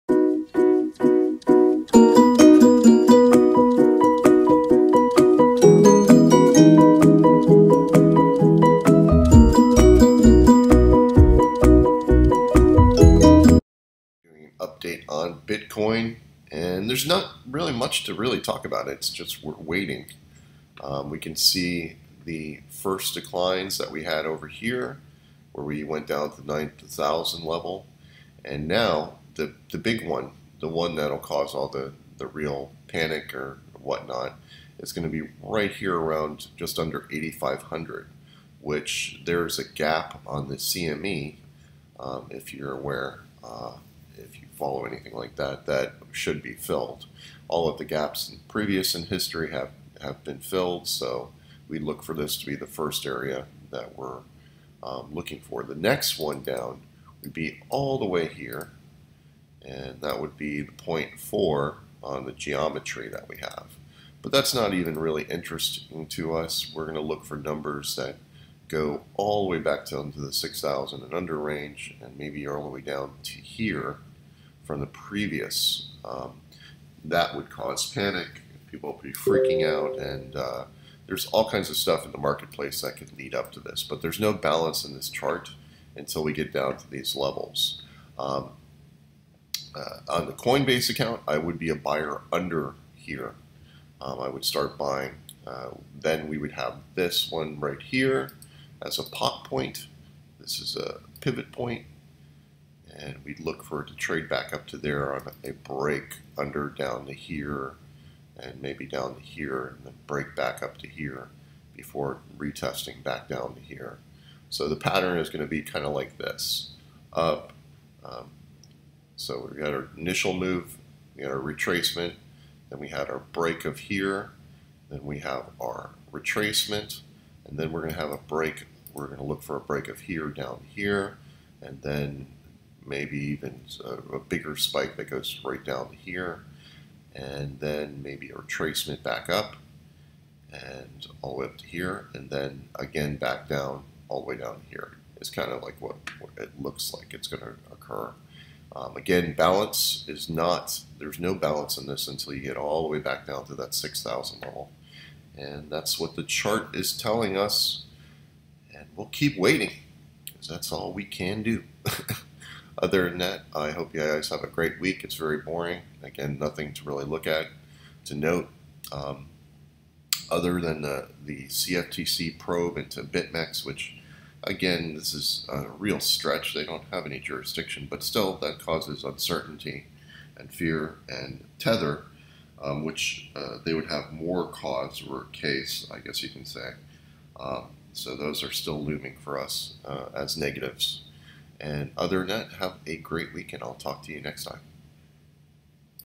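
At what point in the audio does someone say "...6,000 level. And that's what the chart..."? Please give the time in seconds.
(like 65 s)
153 s.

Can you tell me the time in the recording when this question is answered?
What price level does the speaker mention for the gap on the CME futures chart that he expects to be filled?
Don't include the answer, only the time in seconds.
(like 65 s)
36 s.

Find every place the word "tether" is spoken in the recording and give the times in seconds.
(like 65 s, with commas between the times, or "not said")
181 s.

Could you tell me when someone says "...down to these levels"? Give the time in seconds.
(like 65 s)
86 s.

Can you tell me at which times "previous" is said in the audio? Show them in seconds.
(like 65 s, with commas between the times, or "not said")
48 s, 74 s.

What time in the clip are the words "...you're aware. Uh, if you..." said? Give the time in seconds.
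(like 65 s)
42 s.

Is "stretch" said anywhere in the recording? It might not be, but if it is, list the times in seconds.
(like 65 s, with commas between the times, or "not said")
175 s.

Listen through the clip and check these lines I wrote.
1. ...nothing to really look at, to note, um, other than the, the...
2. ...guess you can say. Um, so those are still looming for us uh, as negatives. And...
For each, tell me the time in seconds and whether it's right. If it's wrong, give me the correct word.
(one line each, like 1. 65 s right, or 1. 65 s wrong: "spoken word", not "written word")
1. 166 s right
2. 185 s right.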